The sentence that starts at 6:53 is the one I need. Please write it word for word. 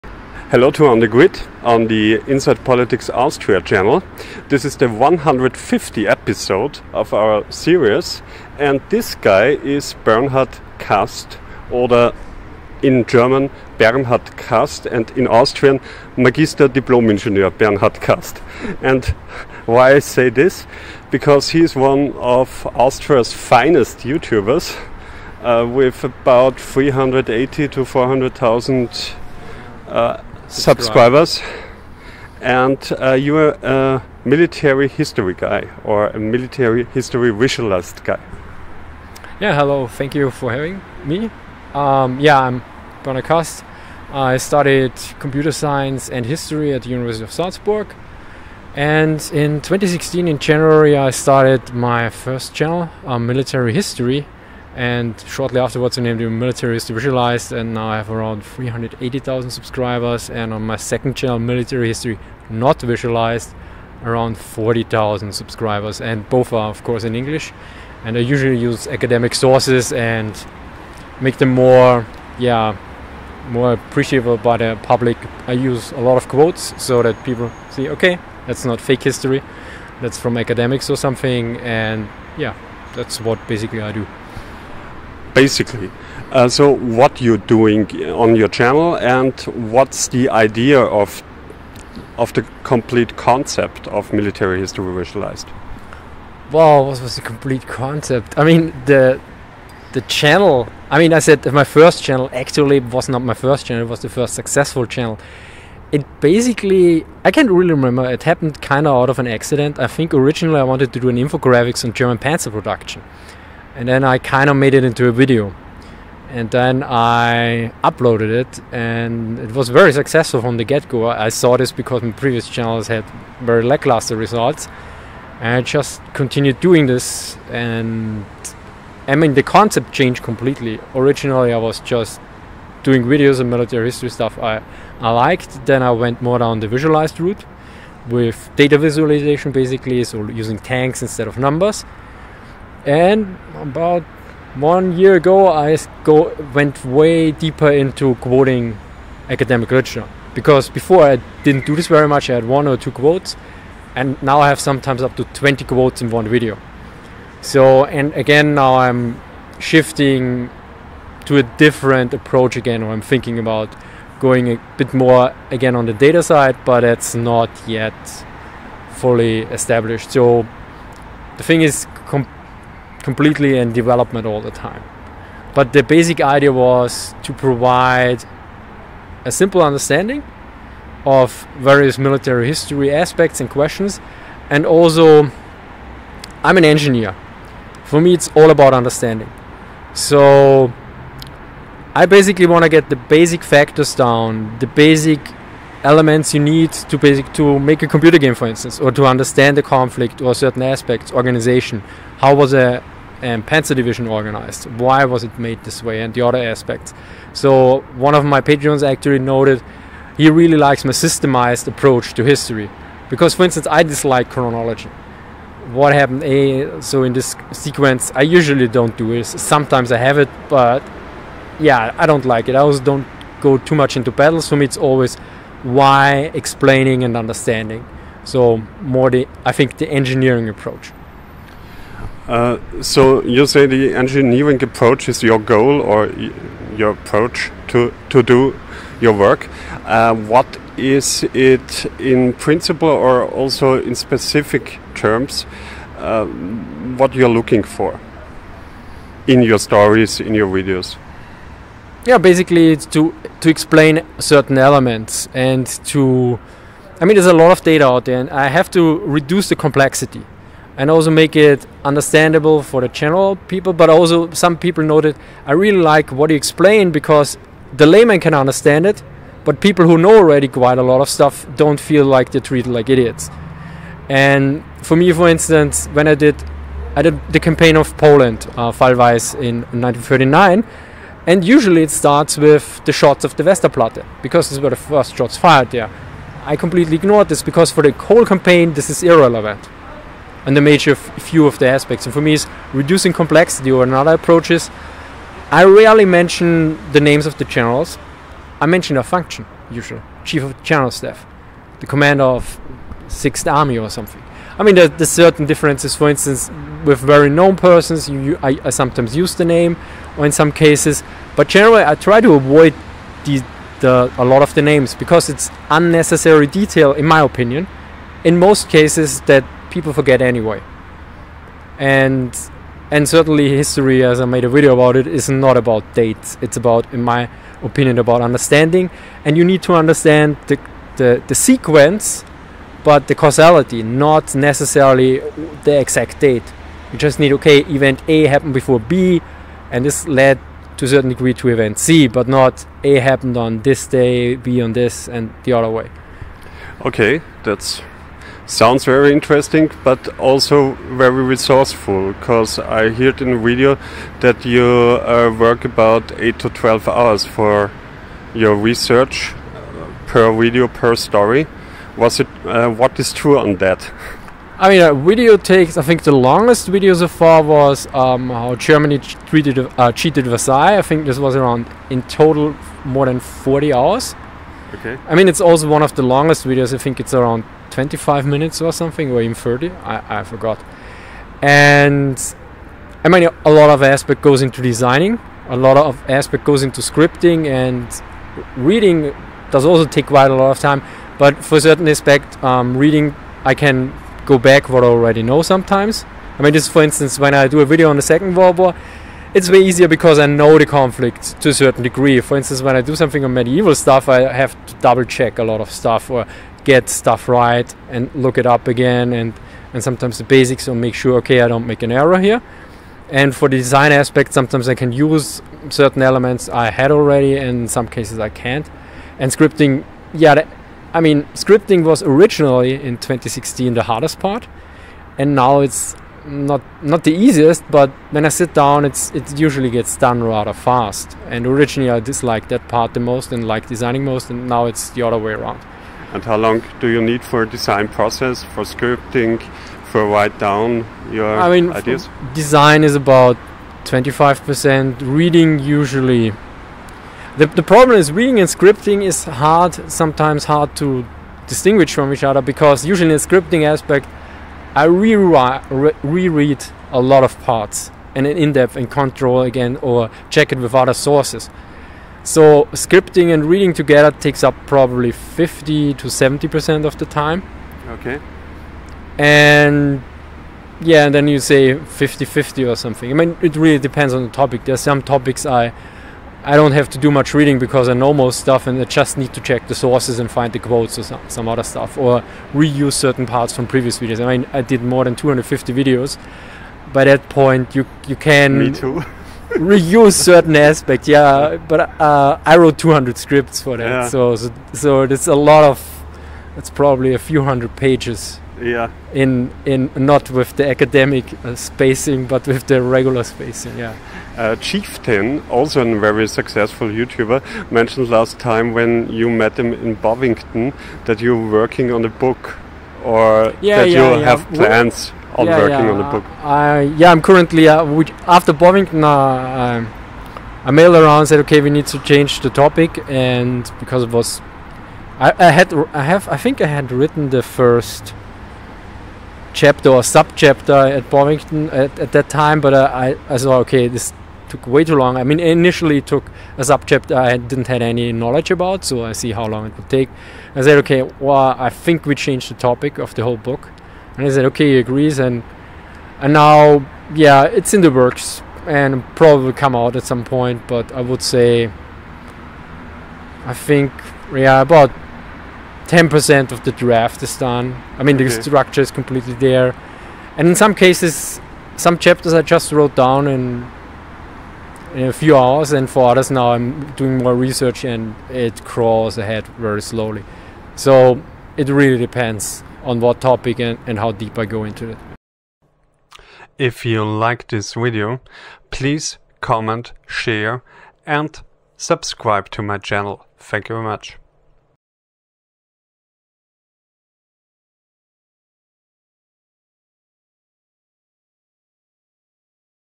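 And for the design aspect, sometimes I can use certain elements I had already and in some cases I can't.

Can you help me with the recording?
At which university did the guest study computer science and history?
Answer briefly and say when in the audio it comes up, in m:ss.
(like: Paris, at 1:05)
University of Salzburg, at 0:46.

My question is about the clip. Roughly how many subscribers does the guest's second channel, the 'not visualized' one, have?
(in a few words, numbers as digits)
40,000.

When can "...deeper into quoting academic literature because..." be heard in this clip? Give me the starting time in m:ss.
2:27.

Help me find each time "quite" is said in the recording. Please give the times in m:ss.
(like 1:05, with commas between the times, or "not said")
4:30, 6:30.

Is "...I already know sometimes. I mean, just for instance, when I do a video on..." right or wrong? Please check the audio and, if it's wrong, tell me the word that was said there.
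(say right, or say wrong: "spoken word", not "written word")
right.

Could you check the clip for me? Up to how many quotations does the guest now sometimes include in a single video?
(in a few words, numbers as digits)
20.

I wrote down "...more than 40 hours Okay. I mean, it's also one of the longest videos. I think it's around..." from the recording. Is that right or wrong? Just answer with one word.
right.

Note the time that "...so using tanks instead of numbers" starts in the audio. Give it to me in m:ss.
2:20.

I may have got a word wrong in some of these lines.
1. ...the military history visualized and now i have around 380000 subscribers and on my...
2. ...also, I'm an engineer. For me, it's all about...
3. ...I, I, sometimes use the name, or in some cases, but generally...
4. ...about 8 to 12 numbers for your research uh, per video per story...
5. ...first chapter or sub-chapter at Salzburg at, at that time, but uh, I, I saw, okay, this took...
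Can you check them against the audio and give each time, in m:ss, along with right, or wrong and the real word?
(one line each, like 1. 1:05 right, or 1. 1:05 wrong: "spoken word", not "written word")
1. 0:56 right
2. 3:04 right
3. 5:08 right
4. 5:55 wrong: "hours", not "numbers"
5. 8:47 wrong: "Bovington", not "Salzburg".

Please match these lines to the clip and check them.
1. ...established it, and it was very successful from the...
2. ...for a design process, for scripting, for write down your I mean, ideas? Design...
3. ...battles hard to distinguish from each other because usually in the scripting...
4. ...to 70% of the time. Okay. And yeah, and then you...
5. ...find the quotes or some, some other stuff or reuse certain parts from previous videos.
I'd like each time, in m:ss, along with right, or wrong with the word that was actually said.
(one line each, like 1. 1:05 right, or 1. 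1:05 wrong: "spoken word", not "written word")
1. 1:57 wrong: "uploaded", not "established"
2. 7:17 right
3. 7:29 wrong: "sometimes", not "battles"
4. 7:45 right
5. 8:00 right.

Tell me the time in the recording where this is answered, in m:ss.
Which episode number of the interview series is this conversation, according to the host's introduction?
0:04.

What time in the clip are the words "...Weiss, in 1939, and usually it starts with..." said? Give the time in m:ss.
4:38.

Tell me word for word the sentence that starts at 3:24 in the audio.
Why was it made this way and the other aspects.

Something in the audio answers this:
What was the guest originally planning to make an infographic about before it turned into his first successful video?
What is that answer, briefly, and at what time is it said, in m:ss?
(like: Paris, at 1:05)
German panzer production, at 1:51.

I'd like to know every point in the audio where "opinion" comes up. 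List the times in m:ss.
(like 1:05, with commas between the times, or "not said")
5:17, 5:27.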